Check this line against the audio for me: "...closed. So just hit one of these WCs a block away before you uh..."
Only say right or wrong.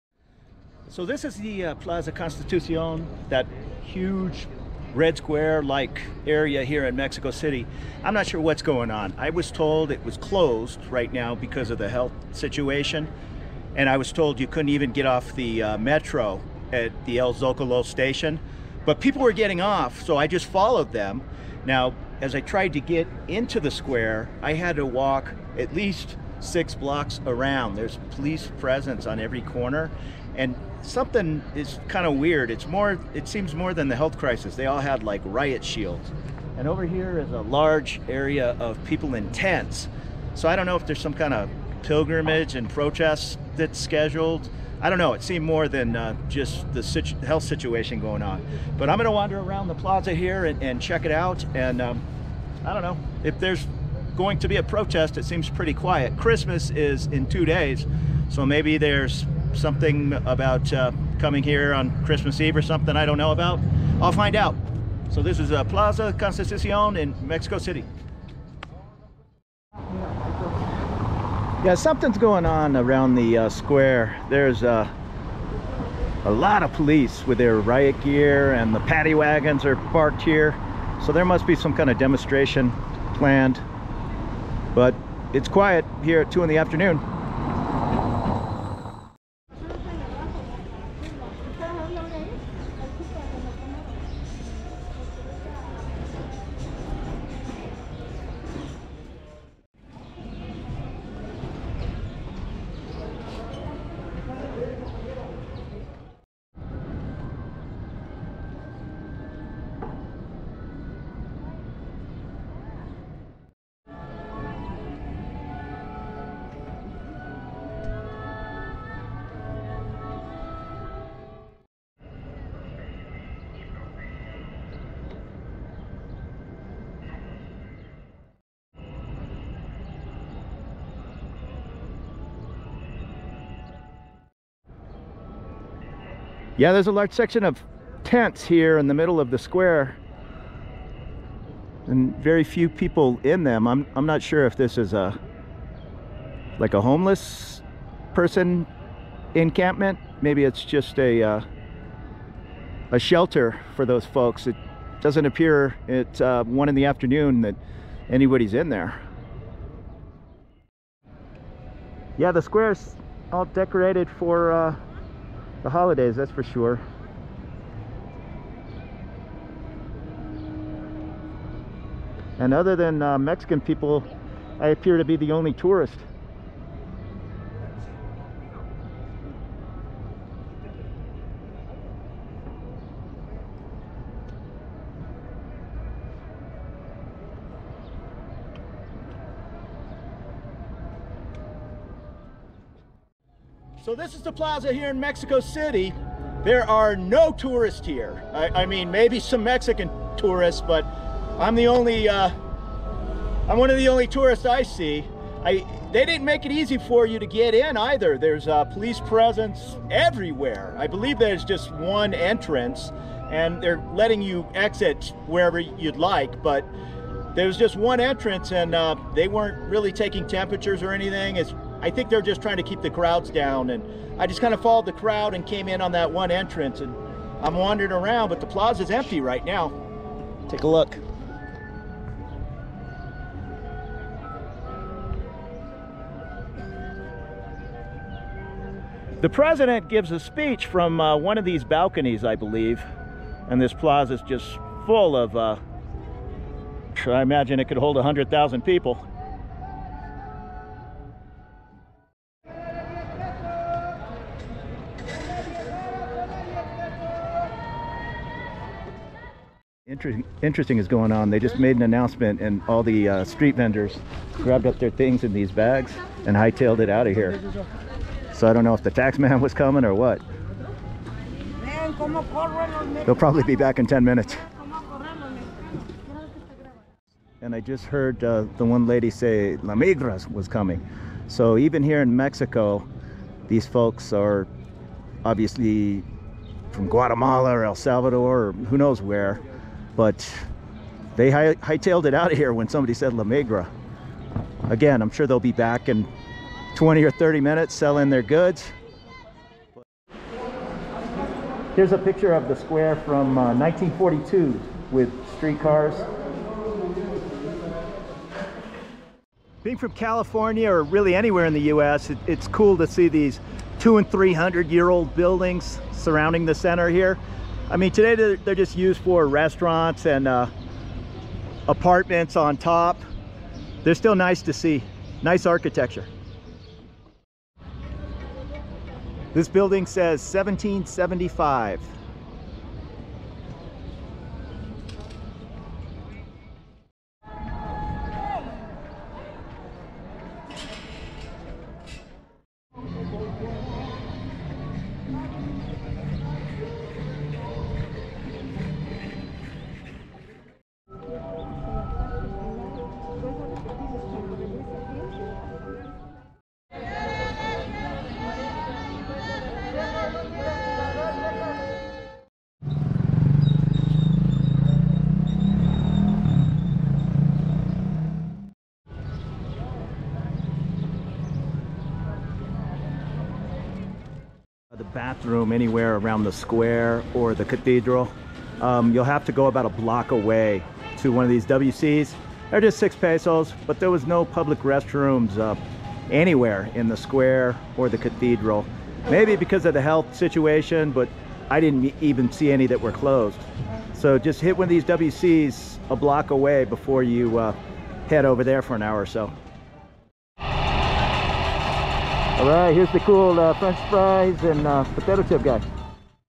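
right.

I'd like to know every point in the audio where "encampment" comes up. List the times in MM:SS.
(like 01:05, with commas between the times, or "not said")
02:29.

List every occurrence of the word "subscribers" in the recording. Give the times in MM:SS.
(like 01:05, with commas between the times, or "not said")
not said.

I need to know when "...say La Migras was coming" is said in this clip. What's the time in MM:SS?
04:39.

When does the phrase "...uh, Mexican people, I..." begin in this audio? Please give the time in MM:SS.
02:53.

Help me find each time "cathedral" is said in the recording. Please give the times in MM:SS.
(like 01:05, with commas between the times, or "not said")
06:17, 06:27.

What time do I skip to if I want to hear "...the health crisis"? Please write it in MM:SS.
00:33.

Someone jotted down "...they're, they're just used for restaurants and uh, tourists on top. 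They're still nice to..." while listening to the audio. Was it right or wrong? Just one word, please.
wrong.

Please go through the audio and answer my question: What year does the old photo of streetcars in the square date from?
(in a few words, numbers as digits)
1942.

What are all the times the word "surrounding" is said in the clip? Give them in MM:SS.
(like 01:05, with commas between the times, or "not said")
05:15.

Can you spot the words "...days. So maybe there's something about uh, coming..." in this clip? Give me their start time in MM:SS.
00:57.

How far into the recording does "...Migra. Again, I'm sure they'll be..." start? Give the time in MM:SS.
04:53.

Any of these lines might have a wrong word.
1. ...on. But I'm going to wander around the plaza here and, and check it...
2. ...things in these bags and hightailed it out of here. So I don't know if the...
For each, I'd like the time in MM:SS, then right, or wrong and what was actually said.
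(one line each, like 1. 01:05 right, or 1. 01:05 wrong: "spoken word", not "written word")
1. 00:48 right
2. 04:24 right.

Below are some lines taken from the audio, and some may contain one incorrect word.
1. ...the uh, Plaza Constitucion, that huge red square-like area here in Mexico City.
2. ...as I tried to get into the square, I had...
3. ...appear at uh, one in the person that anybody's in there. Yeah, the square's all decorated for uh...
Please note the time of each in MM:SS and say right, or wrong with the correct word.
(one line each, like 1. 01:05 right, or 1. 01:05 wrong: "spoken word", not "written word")
1. 00:01 right
2. 00:22 right
3. 02:35 wrong: "afternoon", not "person".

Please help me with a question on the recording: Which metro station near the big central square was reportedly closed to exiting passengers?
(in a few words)
El Zocalo.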